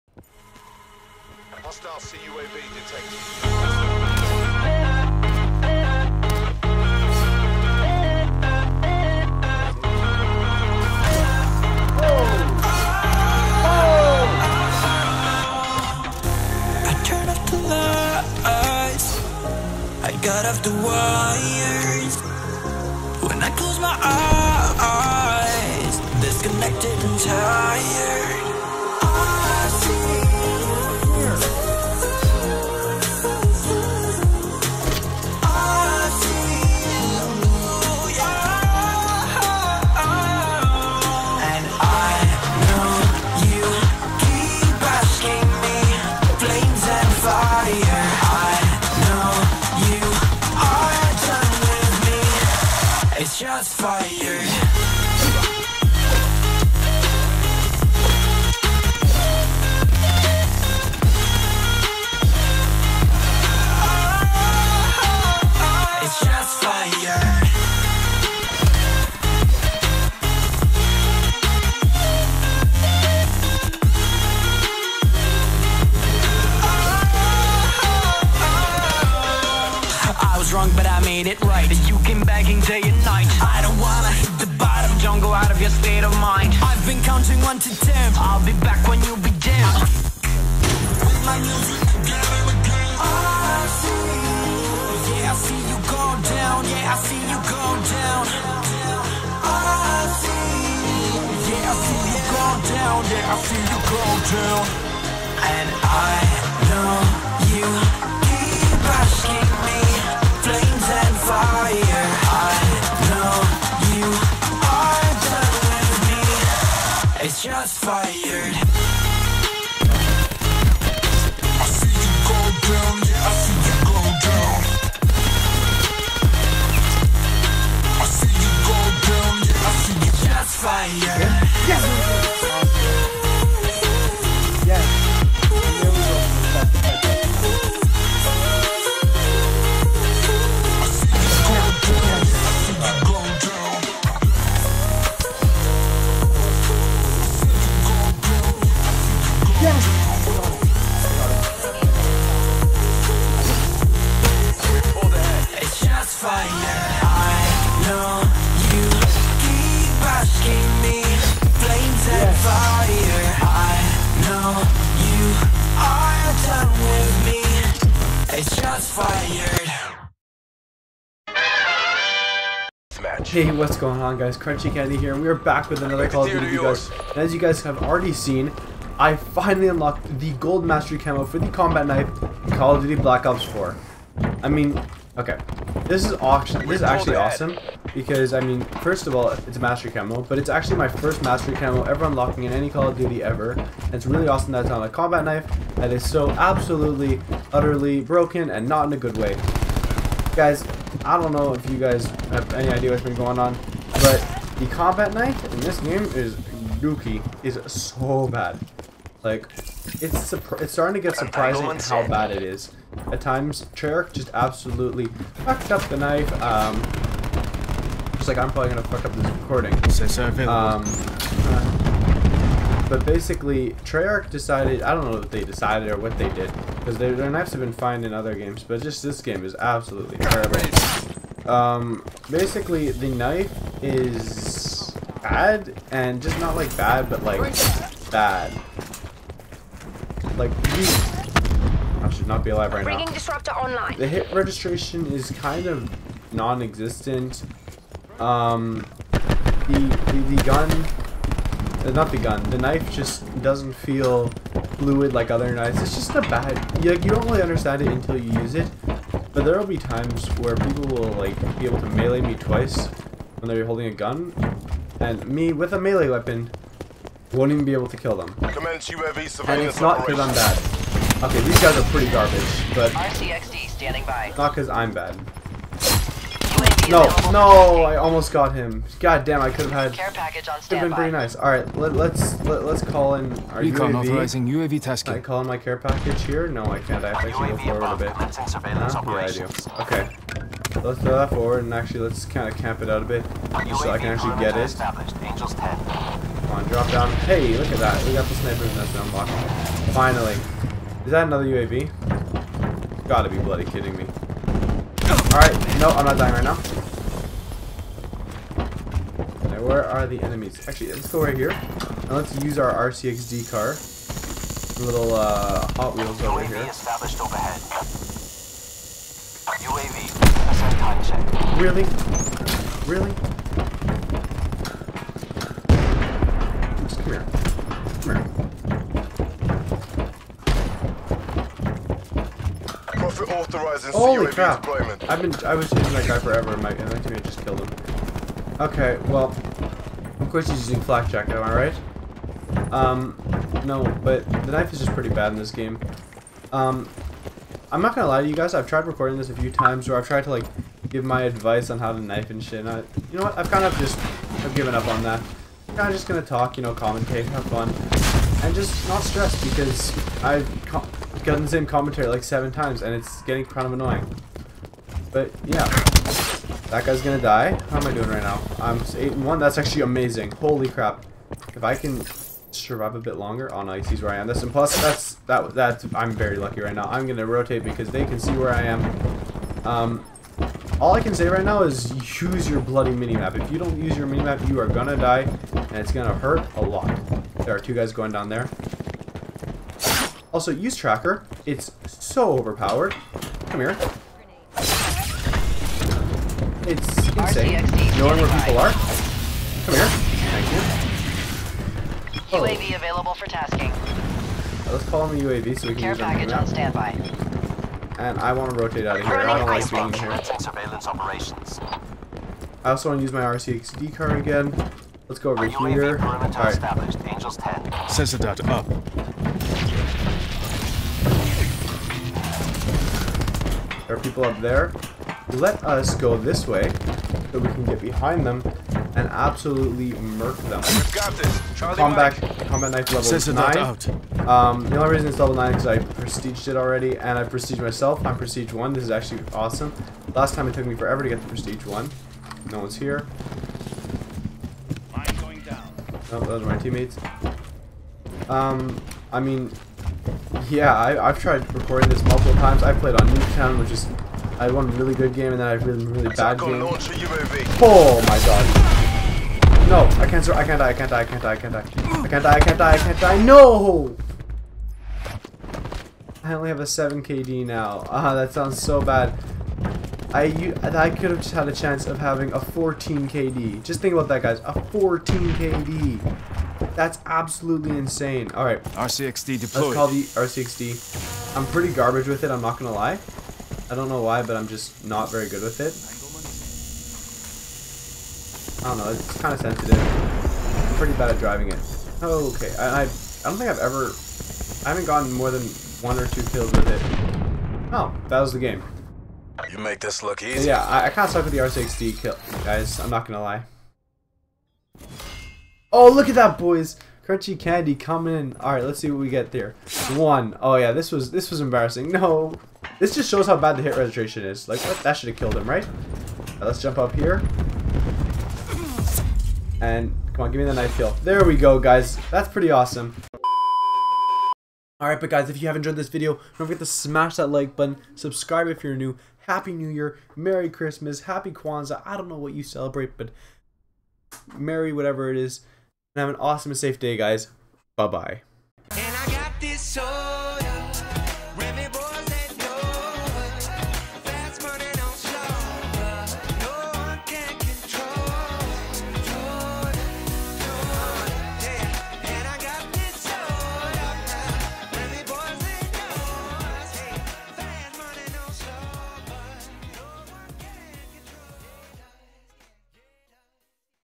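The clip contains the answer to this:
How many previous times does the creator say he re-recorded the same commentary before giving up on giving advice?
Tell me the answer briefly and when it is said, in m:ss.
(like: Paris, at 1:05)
7, at 6:02.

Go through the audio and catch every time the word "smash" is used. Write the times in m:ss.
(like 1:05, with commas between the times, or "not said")
8:46.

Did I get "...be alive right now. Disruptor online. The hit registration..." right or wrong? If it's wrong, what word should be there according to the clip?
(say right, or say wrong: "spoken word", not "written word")
right.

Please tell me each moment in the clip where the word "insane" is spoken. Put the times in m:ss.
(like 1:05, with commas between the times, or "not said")
6:37, 7:57.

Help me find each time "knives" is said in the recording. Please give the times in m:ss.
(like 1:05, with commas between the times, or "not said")
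3:47, 4:15.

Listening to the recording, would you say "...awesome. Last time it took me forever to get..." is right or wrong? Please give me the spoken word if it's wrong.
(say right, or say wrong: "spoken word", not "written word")
right.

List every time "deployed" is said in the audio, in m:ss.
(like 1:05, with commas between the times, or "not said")
7:59.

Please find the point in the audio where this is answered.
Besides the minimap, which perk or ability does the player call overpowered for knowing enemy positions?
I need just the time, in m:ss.
6:30.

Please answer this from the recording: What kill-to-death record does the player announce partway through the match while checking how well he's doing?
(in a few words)
8 and 1.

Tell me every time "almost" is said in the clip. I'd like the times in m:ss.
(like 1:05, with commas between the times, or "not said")
4:37.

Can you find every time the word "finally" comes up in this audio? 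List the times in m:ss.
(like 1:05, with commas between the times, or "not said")
2:59, 4:59.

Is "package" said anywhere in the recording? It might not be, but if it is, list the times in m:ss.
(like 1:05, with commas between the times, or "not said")
4:40, 4:45, 6:45.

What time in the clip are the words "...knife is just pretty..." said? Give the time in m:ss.
5:44.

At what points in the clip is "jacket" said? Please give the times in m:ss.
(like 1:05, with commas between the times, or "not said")
5:40.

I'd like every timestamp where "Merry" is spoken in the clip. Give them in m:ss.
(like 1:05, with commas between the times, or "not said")
8:50, 8:54.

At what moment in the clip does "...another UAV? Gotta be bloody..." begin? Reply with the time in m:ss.
5:01.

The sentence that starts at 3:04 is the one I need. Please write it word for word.
I mean, okay, this is awesome.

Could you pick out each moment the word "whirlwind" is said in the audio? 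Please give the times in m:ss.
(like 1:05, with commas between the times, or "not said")
not said.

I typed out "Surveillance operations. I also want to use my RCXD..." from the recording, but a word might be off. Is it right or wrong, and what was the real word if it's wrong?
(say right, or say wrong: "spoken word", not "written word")
right.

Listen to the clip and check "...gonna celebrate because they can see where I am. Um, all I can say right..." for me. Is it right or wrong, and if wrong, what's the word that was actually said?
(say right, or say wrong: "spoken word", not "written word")
wrong: "rotate", not "celebrate".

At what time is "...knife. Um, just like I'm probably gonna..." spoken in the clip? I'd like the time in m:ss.
3:35.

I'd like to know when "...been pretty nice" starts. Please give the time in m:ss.
4:40.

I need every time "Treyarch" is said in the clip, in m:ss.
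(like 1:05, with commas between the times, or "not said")
3:33, 3:43.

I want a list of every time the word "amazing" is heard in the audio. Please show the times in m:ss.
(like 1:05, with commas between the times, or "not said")
6:09.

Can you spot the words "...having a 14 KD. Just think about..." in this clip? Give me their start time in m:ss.
7:51.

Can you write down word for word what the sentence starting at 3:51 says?
Um, basically, the knife is bad, and just not like bad, but like bad.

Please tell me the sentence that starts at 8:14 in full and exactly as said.
I haven't gotten more than one or two kills with it.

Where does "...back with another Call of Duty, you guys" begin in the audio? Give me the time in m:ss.
2:55.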